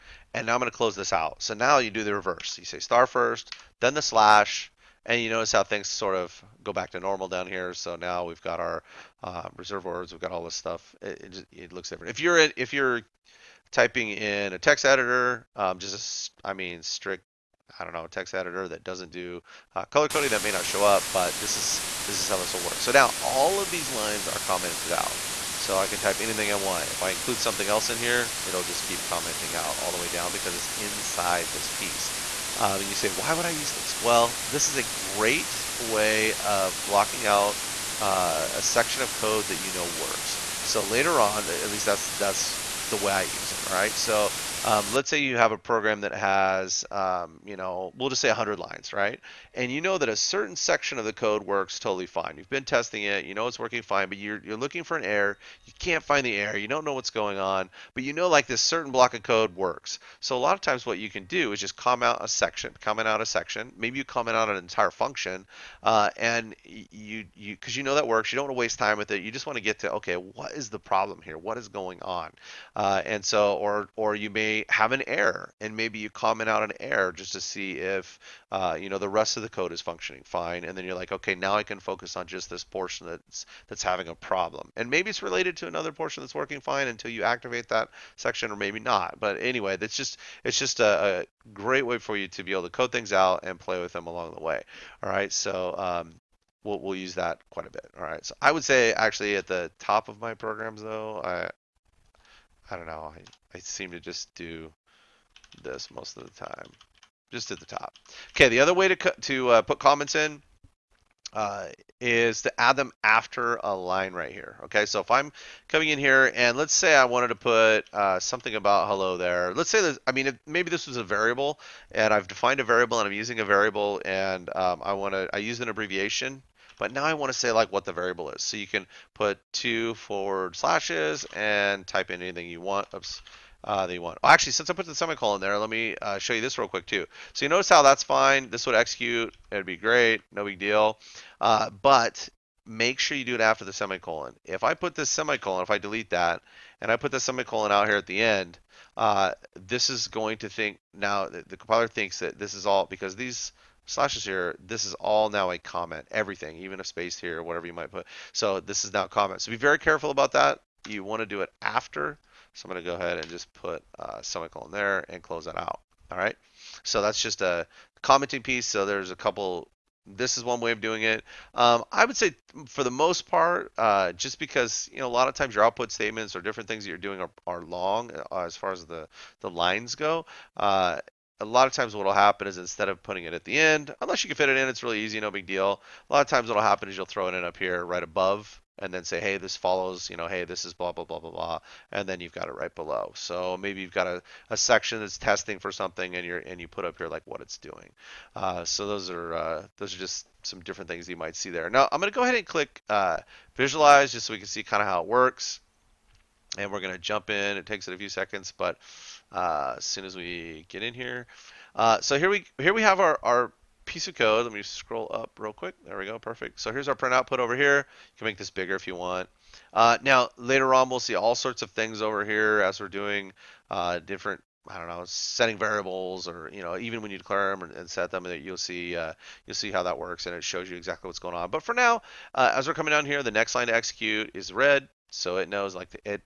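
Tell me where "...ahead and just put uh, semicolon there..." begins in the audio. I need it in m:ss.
2:42.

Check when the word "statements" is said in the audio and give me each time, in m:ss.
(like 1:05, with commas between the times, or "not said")
2:55.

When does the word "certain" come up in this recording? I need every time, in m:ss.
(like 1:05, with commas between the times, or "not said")
0:50, 0:58.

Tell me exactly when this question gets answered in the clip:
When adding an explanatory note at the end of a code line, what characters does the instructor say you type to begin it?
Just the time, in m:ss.
2:09.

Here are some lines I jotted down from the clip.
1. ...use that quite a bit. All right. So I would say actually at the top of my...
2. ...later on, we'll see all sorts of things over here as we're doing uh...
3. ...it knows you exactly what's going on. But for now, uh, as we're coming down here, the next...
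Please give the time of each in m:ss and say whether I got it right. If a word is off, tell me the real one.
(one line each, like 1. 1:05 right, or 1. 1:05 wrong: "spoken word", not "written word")
1. 1:36 right
2. 3:40 right
3. 3:50 wrong: "shows", not "knows".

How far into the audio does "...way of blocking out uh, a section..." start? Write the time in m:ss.
0:35.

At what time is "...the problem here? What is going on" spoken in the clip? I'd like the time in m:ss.
1:10.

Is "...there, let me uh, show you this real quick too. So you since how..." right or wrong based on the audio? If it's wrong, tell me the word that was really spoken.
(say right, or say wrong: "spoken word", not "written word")
wrong: "notice", not "since".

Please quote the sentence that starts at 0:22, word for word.
So now all of these lines are commented out.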